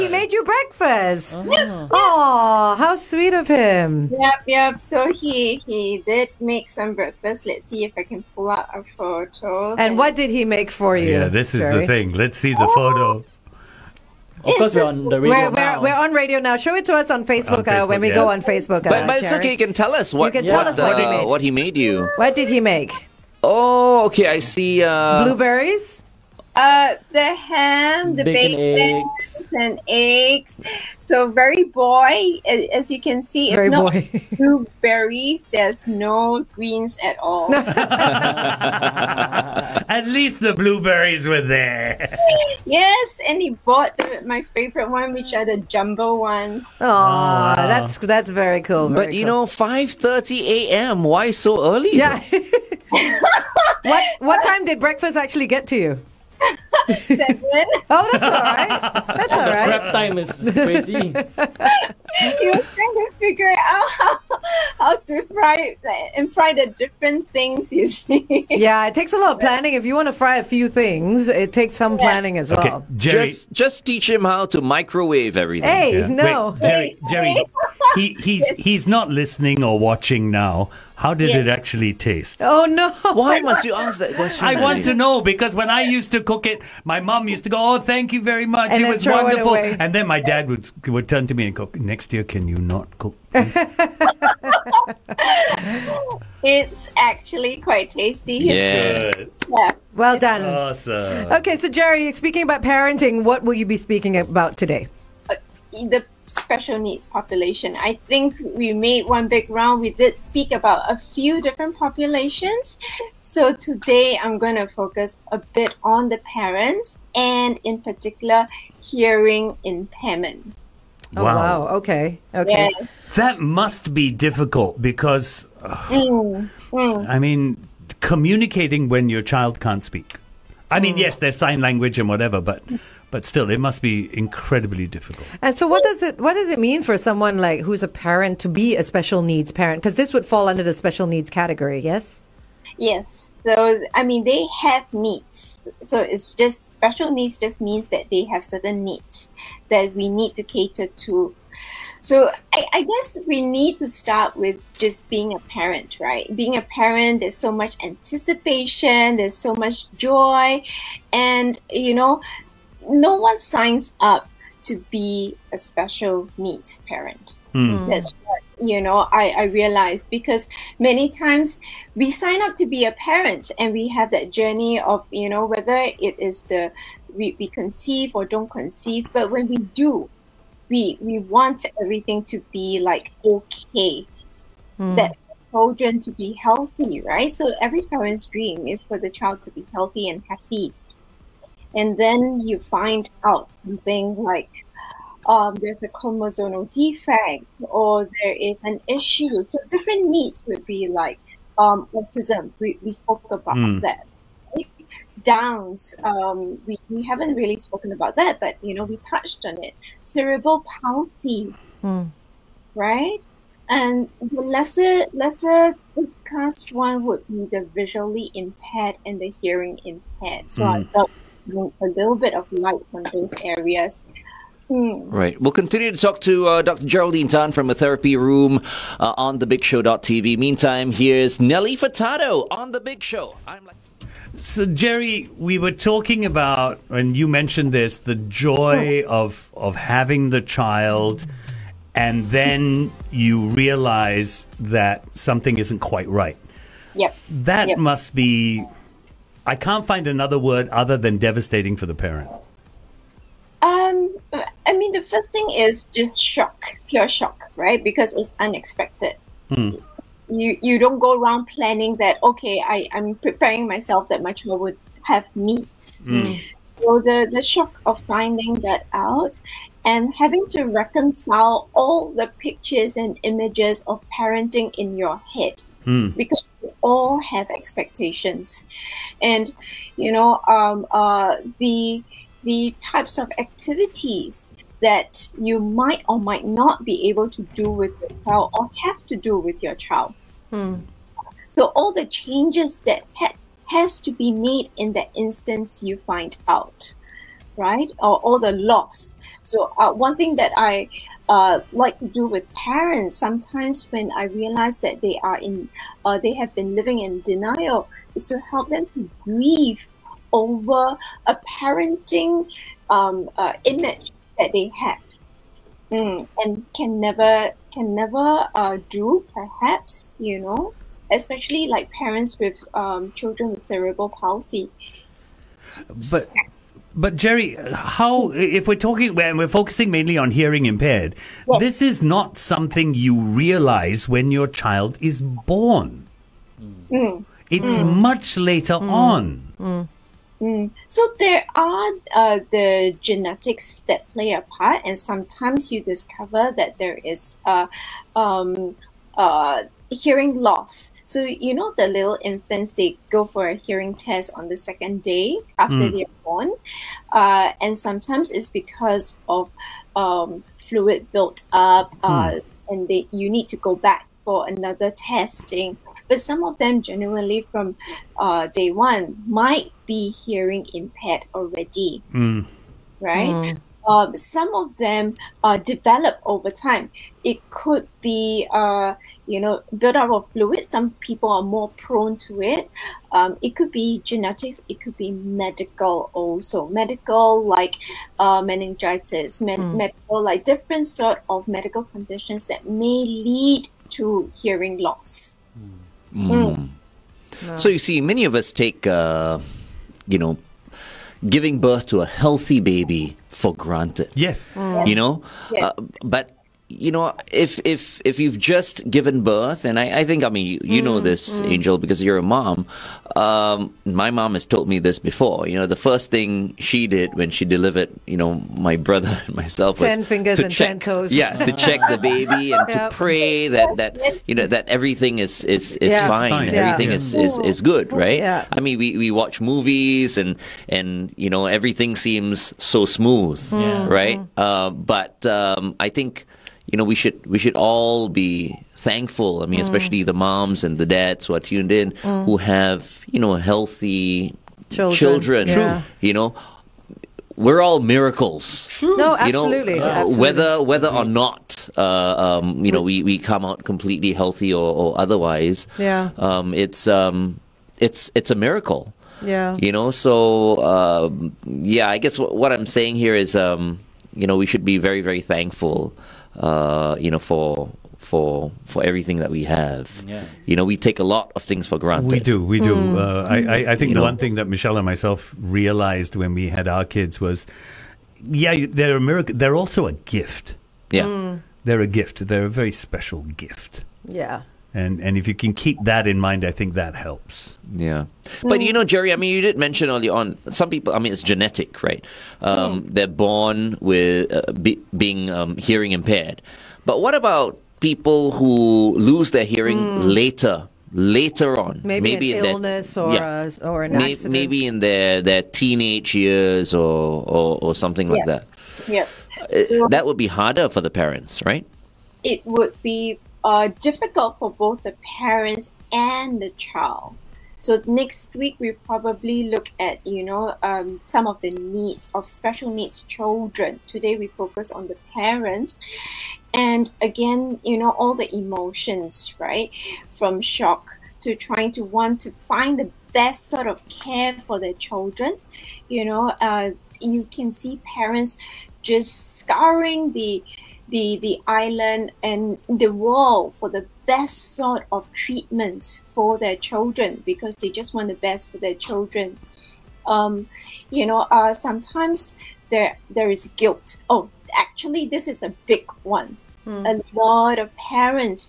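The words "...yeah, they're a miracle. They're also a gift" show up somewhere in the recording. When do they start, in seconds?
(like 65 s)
478 s.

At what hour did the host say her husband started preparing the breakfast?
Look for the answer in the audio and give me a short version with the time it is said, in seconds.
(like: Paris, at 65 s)
5:30 a.m., at 49 s.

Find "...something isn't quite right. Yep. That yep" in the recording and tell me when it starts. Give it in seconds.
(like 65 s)
245 s.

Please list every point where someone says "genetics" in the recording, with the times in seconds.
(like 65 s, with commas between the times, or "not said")
343 s, 384 s, 491 s.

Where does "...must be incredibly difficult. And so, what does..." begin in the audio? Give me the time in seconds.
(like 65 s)
133 s.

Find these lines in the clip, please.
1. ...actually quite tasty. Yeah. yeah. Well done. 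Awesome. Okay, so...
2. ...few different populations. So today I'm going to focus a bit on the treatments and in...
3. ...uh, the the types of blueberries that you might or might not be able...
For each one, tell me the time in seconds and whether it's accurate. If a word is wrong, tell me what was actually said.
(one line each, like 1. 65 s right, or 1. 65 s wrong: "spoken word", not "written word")
1. 96 s right
2. 110 s wrong: "parents", not "treatments"
3. 280 s wrong: "activities", not "blueberries".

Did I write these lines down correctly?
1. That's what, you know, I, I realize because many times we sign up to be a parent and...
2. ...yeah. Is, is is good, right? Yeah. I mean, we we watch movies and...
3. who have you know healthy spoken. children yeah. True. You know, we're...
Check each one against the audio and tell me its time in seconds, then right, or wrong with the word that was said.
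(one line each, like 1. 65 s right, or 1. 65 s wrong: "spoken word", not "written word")
1. 167 s right
2. 426 s right
3. 442 s wrong: "children", not "spoken".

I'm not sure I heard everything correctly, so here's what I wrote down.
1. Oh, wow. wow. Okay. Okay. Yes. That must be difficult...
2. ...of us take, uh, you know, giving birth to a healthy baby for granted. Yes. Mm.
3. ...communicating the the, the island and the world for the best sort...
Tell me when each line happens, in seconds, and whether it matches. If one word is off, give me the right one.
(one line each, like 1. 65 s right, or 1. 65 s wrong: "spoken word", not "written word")
1. 121 s right
2. 398 s right
3. 539 s wrong: "scouring", not "communicating".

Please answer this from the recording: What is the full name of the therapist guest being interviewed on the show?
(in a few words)
Dr. Geraldine Tan.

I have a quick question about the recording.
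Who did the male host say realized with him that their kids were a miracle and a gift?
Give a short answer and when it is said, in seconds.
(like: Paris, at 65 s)
Michelle, at 474 s.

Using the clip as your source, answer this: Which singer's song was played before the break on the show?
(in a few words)
Nelly Furtado.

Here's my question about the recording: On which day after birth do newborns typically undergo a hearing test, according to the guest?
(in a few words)
Second day.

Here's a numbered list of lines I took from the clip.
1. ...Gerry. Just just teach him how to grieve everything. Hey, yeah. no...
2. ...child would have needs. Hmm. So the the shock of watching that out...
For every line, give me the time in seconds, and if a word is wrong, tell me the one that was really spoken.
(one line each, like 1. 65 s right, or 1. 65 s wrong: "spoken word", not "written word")
1. 72 s wrong: "microwave", not "grieve"
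2. 264 s wrong: "finding", not "watching".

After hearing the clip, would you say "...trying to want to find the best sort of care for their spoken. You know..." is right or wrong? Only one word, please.
wrong.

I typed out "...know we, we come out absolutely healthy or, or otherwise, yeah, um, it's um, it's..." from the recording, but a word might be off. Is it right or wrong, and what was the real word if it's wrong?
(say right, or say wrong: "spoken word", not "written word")
wrong: "completely", not "absolutely".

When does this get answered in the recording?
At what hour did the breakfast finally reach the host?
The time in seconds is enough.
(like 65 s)
56 s.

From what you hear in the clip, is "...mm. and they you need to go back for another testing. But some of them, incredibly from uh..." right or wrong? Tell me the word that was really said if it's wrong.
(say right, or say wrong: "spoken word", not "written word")
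wrong: "genuinely", not "incredibly".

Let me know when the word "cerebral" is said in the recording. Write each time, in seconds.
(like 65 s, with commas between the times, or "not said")
210 s, 323 s.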